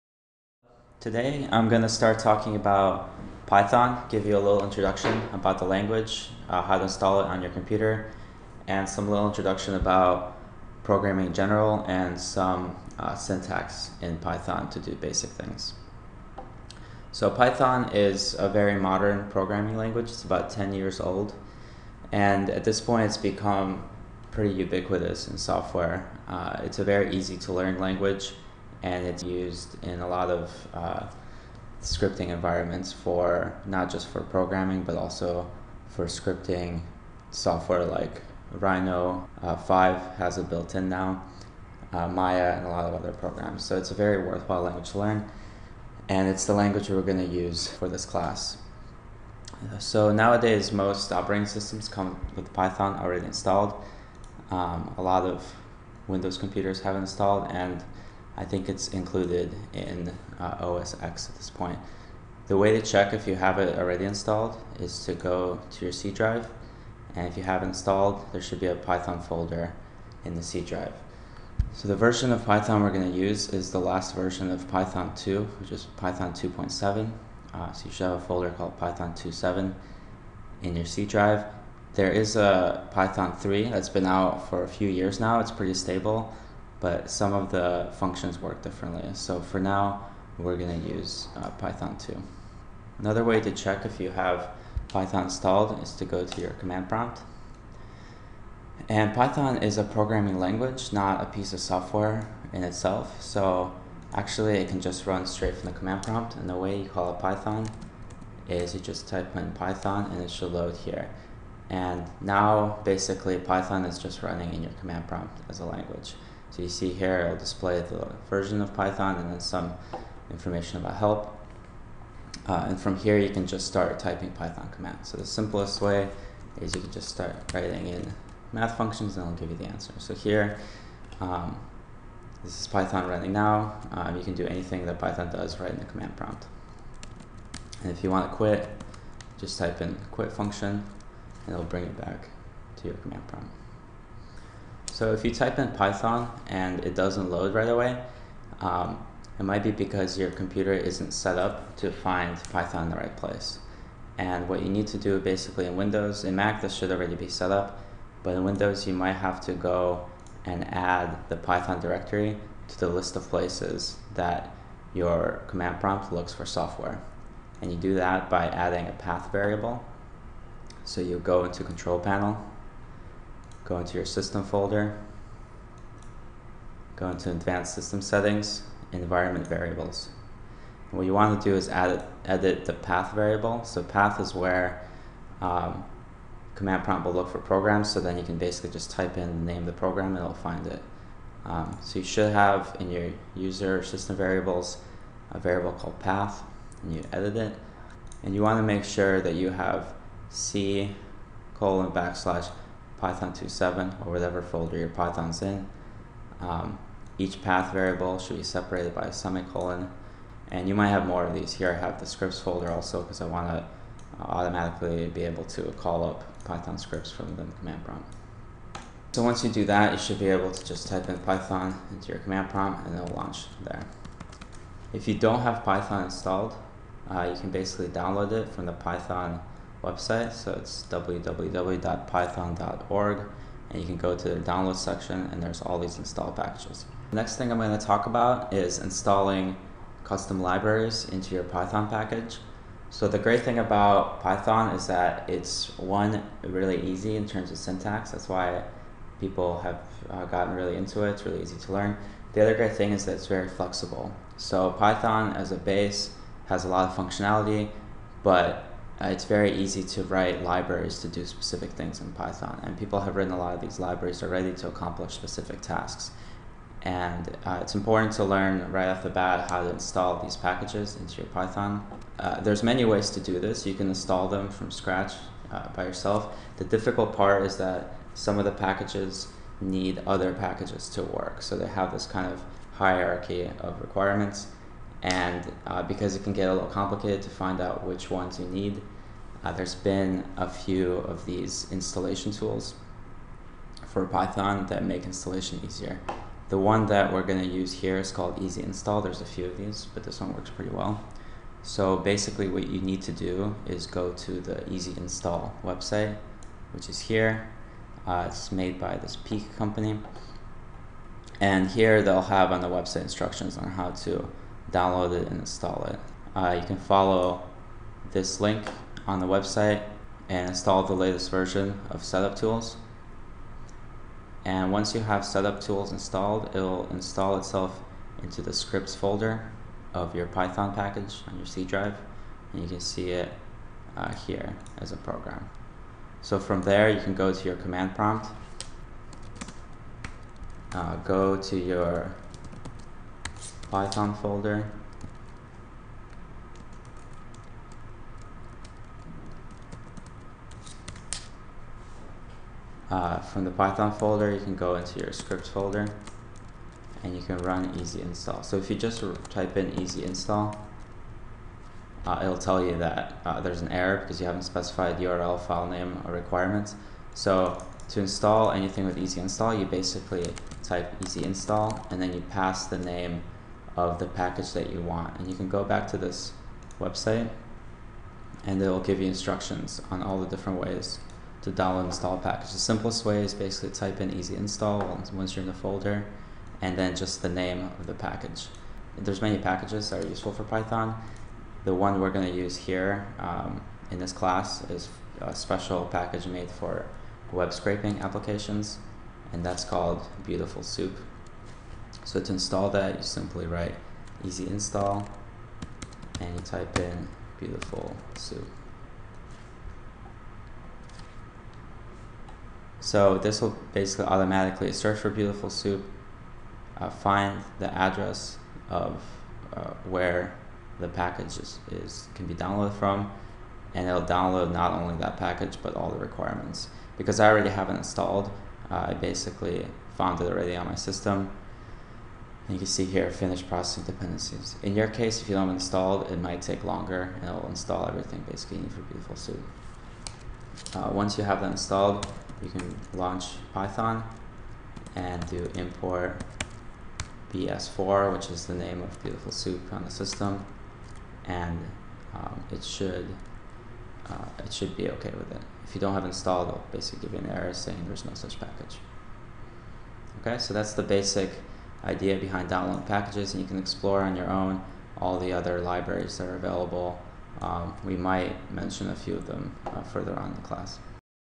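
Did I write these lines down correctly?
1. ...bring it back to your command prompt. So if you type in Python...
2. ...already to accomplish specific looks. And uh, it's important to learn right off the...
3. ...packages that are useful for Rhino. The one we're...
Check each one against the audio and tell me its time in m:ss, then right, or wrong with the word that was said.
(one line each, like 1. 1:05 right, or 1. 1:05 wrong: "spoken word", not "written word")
1. 2:21 right
2. 4:24 wrong: "tasks", not "looks"
3. 6:29 wrong: "Python", not "Rhino".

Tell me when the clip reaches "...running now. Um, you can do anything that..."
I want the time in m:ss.
2:13.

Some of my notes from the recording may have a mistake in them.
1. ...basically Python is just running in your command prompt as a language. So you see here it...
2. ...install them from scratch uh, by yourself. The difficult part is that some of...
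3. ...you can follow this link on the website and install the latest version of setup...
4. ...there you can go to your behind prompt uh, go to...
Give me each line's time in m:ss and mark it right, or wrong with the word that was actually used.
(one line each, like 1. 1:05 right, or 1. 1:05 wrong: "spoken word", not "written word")
1. 1:52 right
2. 4:33 right
3. 5:16 right
4. 5:36 wrong: "command", not "behind".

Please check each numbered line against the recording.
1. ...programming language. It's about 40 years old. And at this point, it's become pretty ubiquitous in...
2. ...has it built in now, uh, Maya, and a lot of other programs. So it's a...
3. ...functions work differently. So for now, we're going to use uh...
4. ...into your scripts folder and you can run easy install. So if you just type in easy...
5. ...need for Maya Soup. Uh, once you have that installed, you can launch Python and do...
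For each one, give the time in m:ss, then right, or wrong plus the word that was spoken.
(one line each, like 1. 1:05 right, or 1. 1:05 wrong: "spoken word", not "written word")
1. 0:19 wrong: "10", not "40"
2. 0:40 right
3. 1:27 right
4. 5:54 right
5. 7:18 wrong: "Beautiful", not "Maya".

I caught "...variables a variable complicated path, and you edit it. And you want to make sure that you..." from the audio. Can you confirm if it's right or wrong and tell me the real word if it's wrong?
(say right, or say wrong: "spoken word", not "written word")
wrong: "called", not "complicated".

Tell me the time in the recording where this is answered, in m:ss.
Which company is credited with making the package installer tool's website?
5:09.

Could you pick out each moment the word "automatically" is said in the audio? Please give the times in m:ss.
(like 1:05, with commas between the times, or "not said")
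3:34, 6:54.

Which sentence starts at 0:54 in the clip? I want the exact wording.
Um, a lot of Windows computers have installed, and I think it's included in uh, OS X at this point.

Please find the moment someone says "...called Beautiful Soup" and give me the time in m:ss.
6:39.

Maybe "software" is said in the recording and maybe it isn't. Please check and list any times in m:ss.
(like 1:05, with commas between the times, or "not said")
0:25, 0:37, 1:41, 2:46.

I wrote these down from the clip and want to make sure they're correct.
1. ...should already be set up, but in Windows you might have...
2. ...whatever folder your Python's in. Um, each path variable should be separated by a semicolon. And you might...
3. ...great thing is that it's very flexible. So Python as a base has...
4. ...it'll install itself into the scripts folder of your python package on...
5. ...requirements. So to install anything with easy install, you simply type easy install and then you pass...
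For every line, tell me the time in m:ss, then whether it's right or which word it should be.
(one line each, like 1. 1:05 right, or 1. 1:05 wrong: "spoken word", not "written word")
1. 2:36 right
2. 3:24 right
3. 4:12 right
4. 5:26 right
5. 6:06 wrong: "basically", not "simply".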